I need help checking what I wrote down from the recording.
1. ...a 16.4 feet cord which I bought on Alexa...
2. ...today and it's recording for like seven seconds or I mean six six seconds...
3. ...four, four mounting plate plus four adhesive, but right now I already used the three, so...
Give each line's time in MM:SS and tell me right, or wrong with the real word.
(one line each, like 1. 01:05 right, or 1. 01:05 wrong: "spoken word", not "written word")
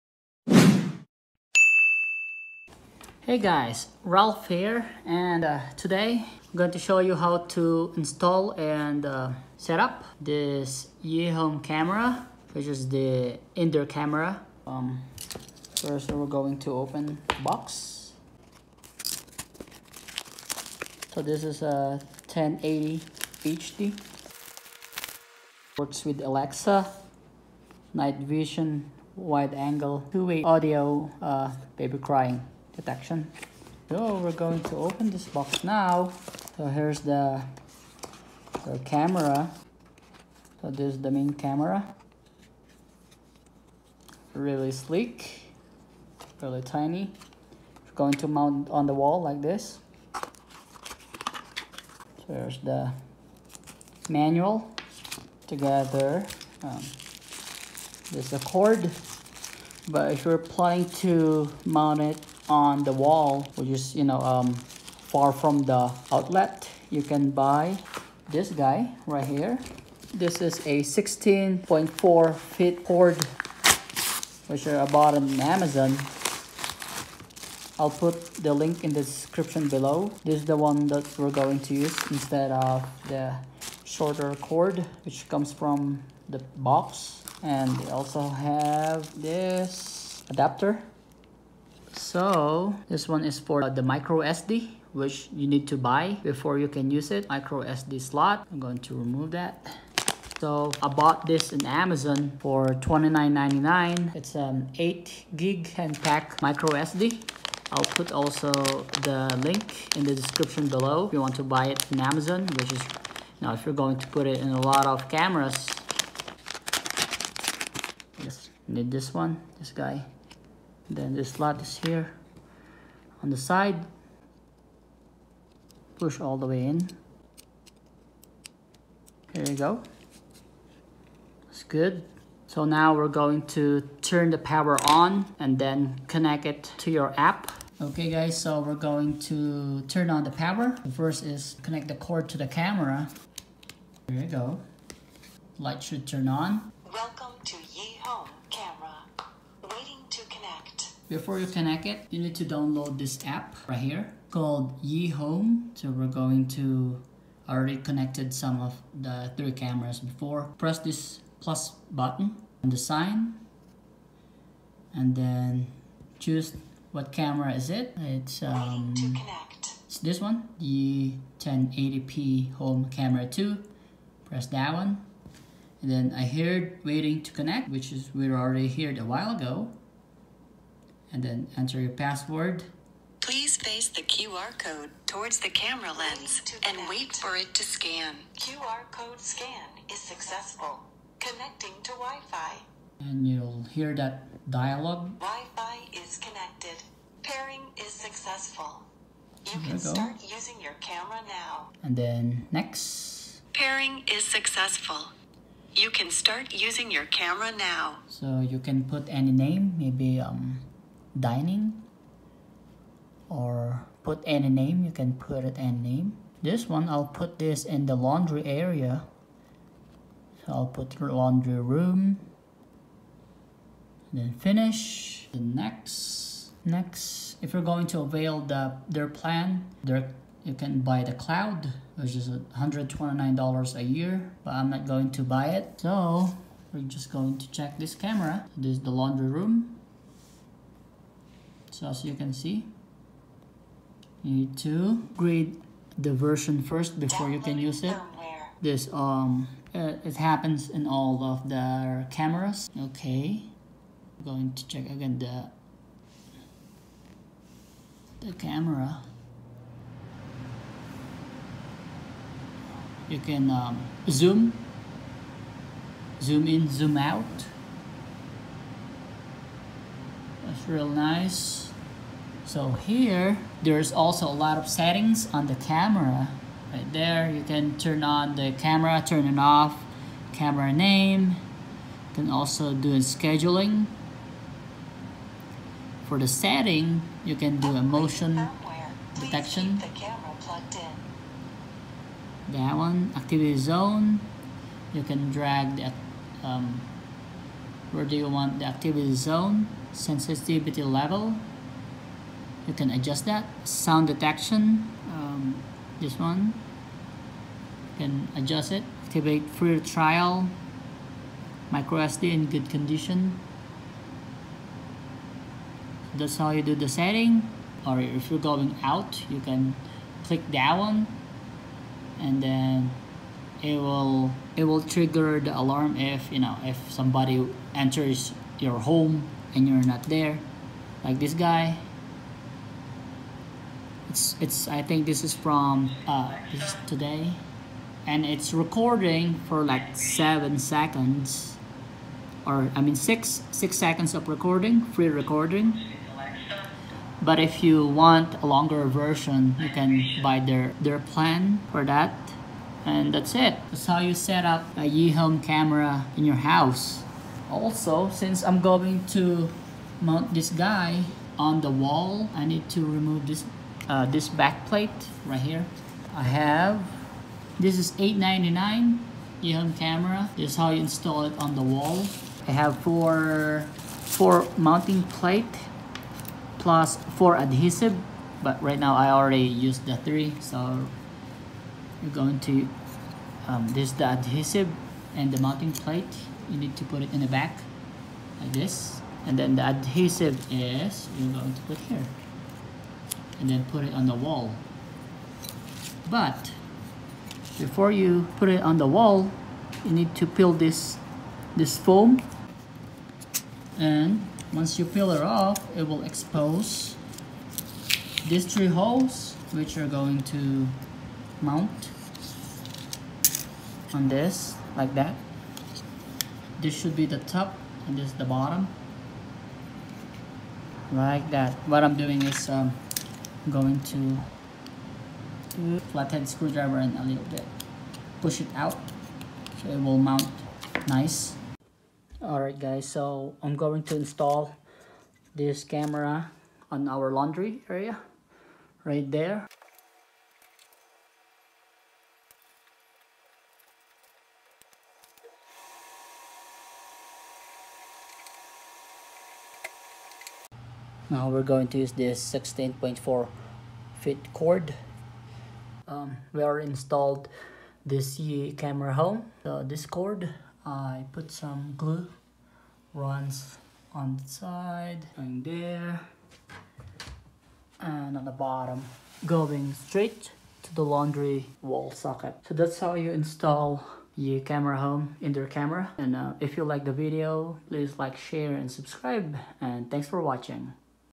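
1. 01:10 wrong: "Amazon", not "Alexa"
2. 05:36 right
3. 06:12 right.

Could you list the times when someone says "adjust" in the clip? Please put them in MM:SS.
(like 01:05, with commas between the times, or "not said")
05:02, 05:08.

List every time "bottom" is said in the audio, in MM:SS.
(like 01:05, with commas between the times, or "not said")
06:58, 07:48.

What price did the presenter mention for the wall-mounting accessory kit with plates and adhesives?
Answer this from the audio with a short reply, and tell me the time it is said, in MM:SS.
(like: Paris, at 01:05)
$8.99, at 06:07.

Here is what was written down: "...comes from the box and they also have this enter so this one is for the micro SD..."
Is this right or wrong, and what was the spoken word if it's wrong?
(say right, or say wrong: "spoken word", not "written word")
wrong: "adapter", not "enter".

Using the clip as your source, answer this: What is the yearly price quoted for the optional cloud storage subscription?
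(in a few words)
$129.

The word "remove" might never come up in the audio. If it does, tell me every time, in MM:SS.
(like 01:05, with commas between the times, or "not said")
01:38, 06:02.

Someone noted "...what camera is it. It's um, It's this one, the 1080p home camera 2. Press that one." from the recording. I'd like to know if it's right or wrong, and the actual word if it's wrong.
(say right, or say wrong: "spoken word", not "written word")
right.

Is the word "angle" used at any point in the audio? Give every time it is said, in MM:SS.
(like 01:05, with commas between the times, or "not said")
00:29.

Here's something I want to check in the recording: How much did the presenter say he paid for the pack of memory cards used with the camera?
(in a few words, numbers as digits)
$29.99.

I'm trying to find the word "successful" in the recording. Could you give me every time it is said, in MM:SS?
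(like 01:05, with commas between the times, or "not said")
03:09, 03:17, 03:24.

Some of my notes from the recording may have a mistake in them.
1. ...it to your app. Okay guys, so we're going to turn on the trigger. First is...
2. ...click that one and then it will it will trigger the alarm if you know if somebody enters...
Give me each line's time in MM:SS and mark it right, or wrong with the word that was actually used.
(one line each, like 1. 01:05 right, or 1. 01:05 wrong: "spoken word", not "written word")
1. 02:16 wrong: "power", not "trigger"
2. 05:20 right.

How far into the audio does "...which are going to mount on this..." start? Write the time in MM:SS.
06:49.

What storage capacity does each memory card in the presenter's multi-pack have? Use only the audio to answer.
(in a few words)
8 gig.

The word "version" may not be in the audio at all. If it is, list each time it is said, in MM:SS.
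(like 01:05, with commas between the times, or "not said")
04:06, 05:48.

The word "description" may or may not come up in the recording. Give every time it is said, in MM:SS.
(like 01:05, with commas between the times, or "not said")
01:19, 01:50.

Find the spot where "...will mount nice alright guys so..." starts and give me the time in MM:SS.
07:09.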